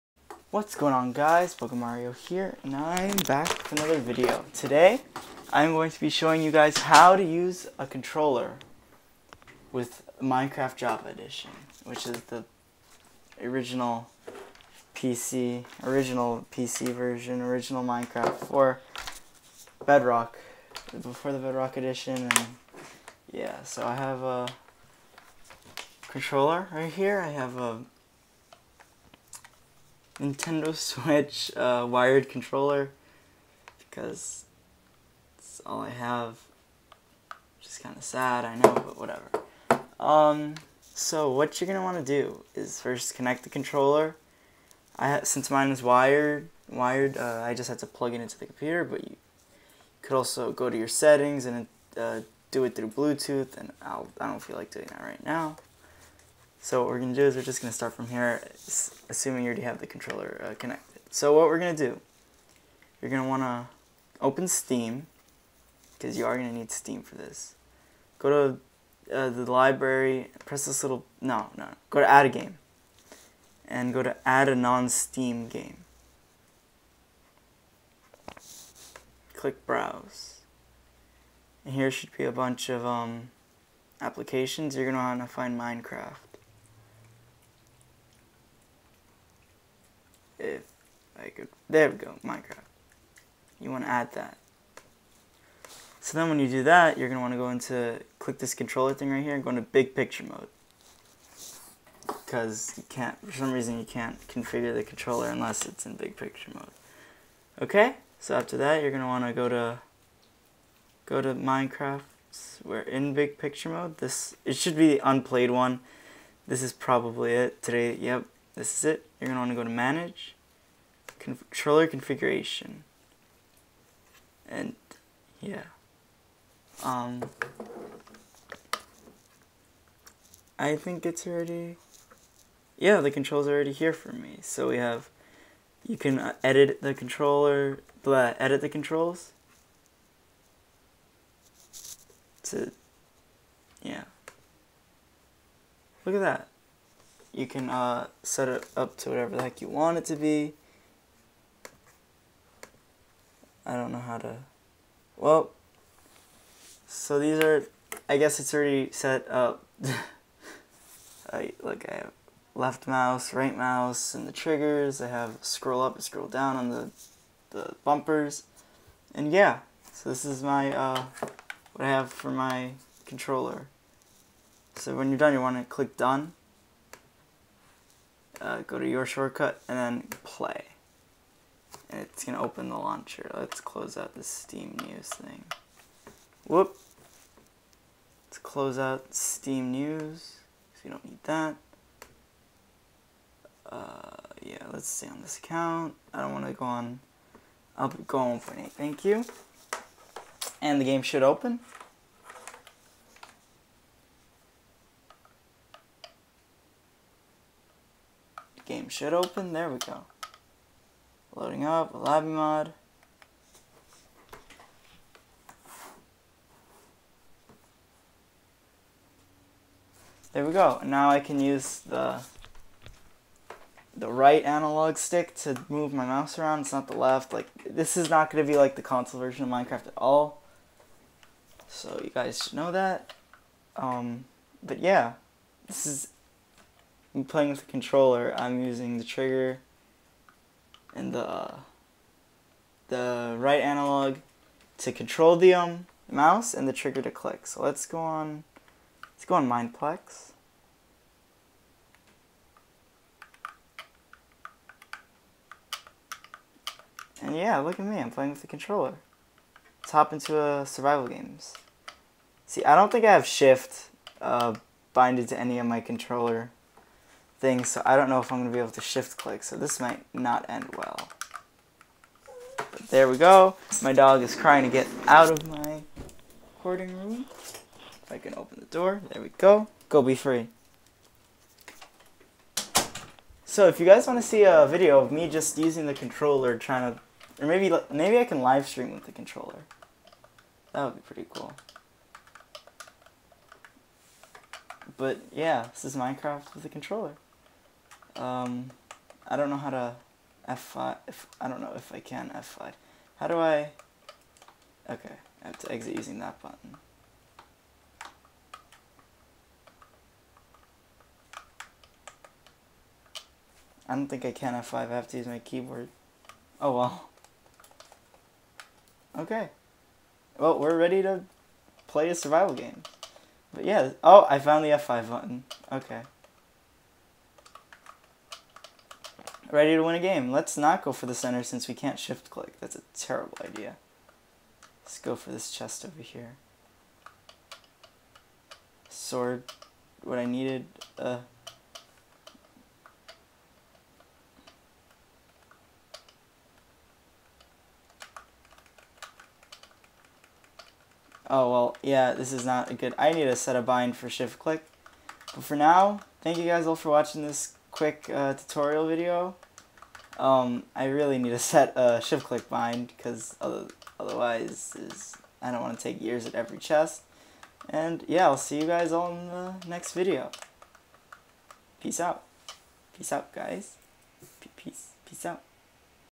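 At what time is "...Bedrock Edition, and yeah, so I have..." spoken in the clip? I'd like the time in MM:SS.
00:21.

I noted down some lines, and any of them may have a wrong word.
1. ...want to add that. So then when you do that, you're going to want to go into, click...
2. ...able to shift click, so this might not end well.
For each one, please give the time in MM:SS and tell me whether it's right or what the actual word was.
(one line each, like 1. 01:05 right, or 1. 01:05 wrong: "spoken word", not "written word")
1. 01:33 right
2. 04:28 right.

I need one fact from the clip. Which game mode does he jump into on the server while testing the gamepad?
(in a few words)
Survival games.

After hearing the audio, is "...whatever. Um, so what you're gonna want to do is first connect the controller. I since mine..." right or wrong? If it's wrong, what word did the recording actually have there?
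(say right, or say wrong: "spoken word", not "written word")
right.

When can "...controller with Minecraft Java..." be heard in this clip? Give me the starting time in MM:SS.
00:07.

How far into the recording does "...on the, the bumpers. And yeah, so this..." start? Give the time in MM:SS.
02:46.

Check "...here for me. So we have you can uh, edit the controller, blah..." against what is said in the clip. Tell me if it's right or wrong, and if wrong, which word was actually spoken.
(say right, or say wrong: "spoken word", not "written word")
right.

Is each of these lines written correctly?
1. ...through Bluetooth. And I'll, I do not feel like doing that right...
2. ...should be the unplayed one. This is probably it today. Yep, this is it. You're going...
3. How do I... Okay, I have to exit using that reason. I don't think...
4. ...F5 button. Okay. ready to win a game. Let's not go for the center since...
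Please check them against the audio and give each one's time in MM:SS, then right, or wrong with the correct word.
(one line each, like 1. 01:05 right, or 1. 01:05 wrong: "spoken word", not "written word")
1. 00:52 right
2. 01:54 right
3. 05:03 wrong: "button", not "reason"
4. 05:24 right.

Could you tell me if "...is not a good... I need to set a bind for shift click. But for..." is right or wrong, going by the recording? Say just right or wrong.
right.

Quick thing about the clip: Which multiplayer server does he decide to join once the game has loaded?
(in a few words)
Mineplex.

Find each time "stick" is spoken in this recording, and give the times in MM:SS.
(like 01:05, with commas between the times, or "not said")
03:44.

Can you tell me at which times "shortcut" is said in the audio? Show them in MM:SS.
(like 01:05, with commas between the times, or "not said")
02:59.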